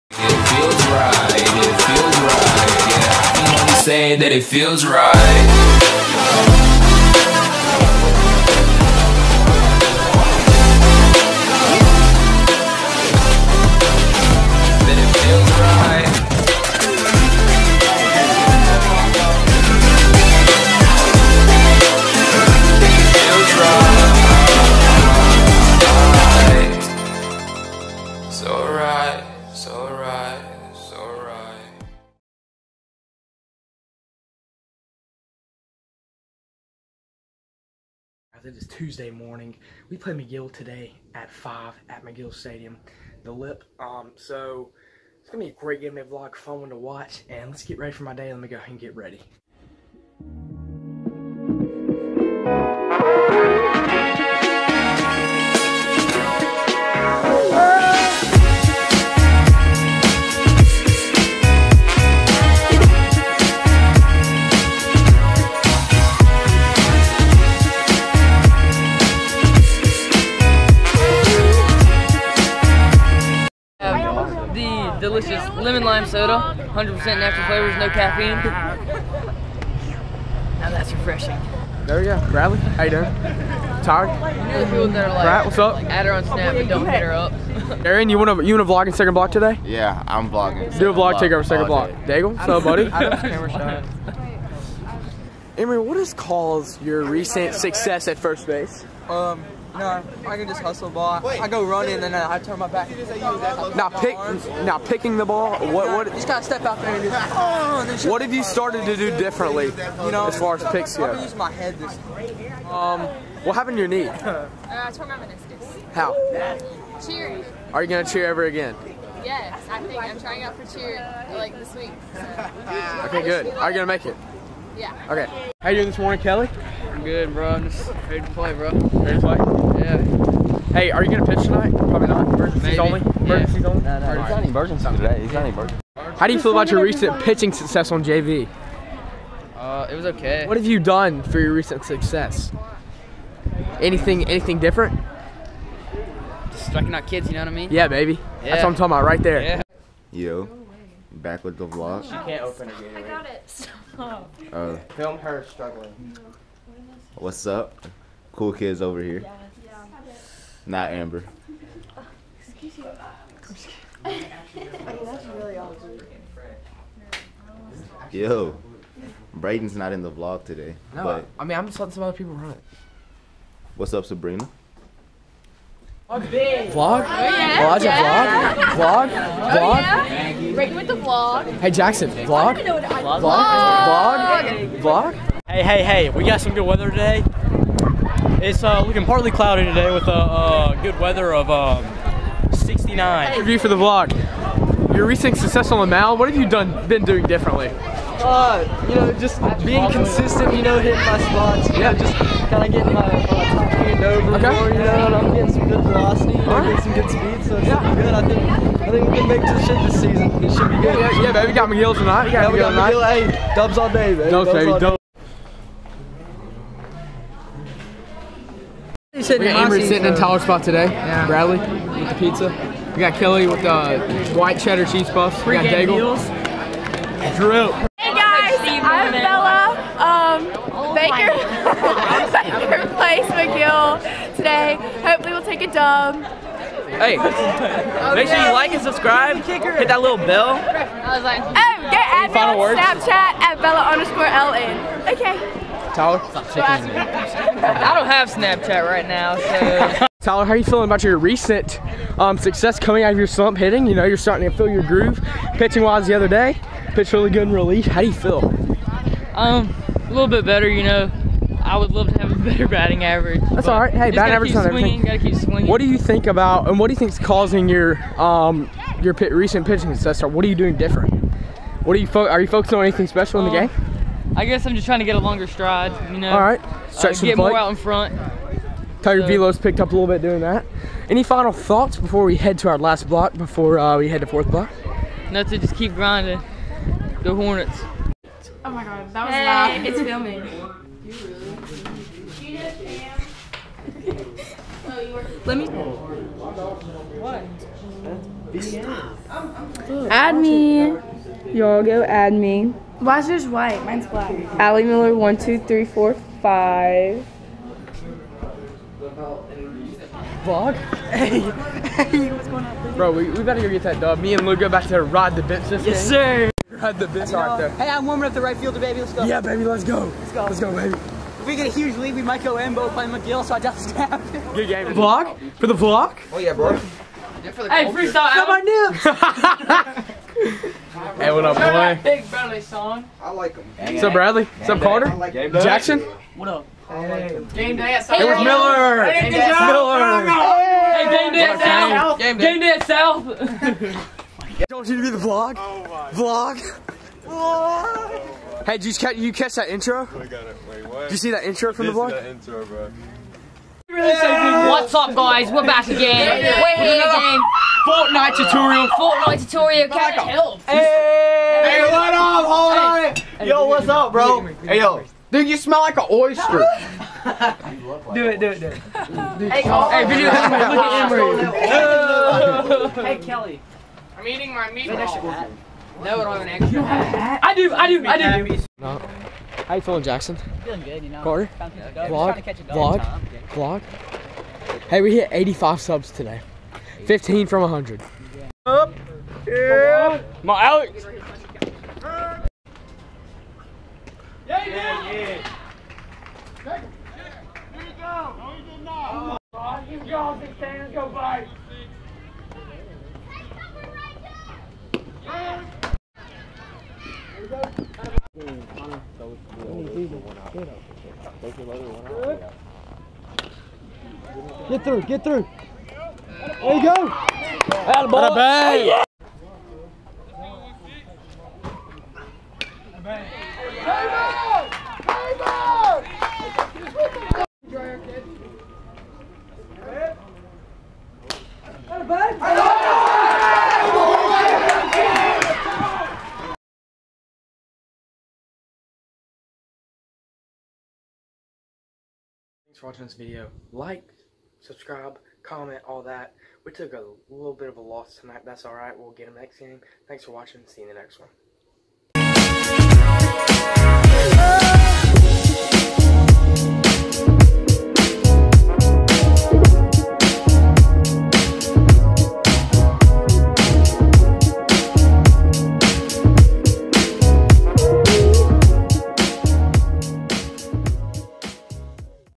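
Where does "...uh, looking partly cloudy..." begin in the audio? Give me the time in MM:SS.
03:08.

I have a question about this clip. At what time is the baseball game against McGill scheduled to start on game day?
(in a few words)
5.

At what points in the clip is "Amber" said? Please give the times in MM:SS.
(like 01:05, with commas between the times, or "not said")
02:40.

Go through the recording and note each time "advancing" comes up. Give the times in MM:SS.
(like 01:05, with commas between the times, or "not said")
not said.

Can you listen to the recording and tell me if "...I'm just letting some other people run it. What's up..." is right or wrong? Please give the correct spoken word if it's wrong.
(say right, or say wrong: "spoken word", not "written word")
right.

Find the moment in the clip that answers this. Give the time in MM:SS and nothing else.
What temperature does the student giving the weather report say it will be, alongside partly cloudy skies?
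03:12.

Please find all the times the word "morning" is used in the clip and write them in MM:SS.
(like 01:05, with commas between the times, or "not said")
00:39, 02:05.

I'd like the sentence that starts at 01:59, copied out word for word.
Yes, I think I'm trying out for cheer like this week.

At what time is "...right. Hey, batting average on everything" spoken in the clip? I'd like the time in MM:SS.
04:23.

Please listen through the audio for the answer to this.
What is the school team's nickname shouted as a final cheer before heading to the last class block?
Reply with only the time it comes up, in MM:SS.
04:47.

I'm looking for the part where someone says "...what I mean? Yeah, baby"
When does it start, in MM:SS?
02:27.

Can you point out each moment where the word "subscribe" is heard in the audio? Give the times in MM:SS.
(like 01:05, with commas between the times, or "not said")
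03:58, 07:24.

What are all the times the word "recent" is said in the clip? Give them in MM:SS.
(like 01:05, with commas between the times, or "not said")
01:37, 02:16, 02:21, 03:15, 04:11, 04:29.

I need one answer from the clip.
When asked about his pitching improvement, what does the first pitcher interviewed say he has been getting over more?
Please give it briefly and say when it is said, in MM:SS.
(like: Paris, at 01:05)
top hand, at 03:23.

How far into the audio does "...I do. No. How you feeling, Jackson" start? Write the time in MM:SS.
06:18.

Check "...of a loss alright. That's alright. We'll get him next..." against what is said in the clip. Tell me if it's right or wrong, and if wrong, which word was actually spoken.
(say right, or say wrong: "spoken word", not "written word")
wrong: "tonight", not "alright".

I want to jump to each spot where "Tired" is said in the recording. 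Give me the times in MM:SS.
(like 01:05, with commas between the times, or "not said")
01:23.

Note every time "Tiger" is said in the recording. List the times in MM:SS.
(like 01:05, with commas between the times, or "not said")
04:39.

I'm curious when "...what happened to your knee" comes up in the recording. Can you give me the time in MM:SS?
01:53.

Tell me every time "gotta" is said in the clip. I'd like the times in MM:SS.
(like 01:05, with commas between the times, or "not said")
01:46, 04:25.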